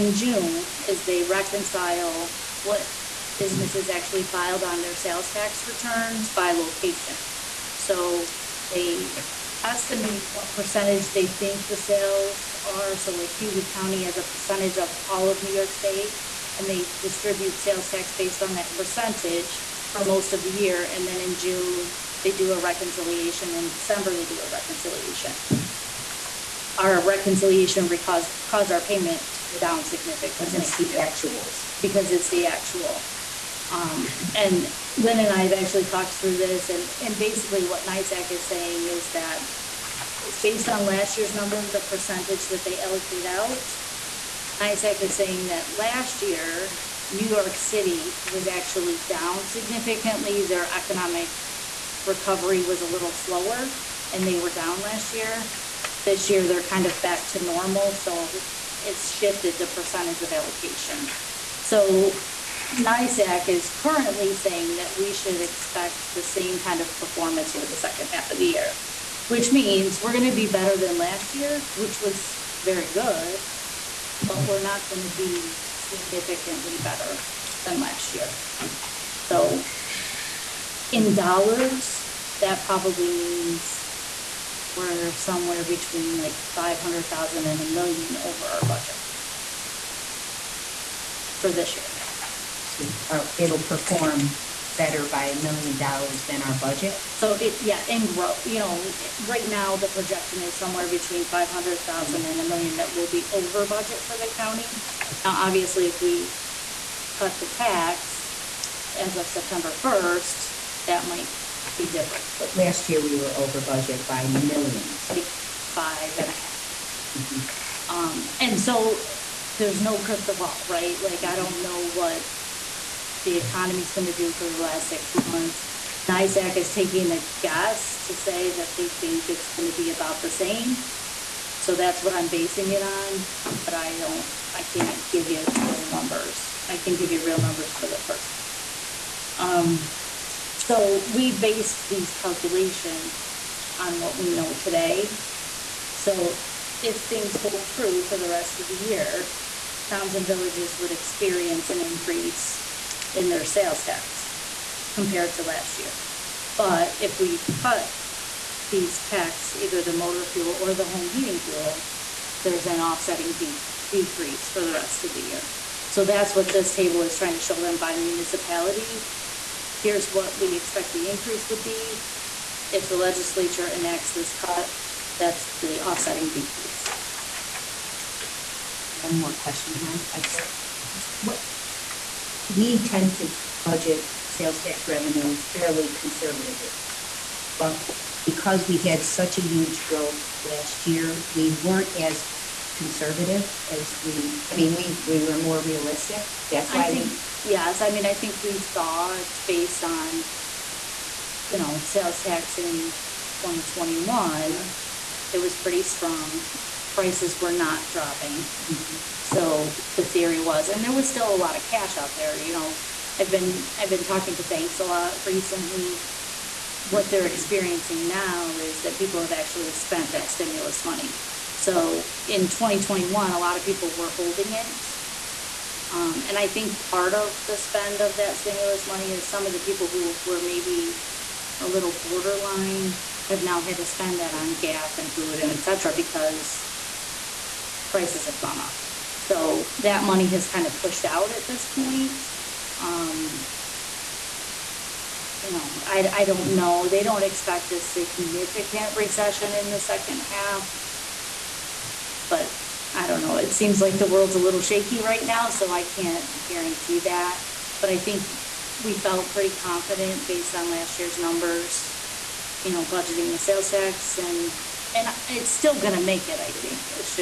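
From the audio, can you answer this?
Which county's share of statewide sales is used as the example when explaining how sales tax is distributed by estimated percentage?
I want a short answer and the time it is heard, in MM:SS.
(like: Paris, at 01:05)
Cayuga County, at 00:13.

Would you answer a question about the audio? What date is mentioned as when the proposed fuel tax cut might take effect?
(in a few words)
September 1.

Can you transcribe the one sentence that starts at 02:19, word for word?
Um, so we based these calculations on what we know today.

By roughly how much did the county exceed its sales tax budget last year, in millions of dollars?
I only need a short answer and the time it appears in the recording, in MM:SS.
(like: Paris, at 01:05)
5.5 million, at 01:55.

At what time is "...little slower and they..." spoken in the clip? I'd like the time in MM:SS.
00:52.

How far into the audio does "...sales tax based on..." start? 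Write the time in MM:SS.
00:17.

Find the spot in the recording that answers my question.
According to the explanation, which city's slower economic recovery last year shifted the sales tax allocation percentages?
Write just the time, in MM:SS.
00:47.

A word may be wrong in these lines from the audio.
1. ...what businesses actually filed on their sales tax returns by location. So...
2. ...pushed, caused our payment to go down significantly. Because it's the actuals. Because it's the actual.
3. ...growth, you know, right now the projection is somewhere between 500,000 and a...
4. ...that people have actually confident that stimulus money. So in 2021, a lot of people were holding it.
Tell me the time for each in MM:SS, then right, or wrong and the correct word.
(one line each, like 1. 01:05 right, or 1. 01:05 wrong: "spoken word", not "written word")
1. 00:02 right
2. 00:28 wrong: "caused", not "pushed"
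3. 01:38 right
4. 03:38 wrong: "spent", not "confident".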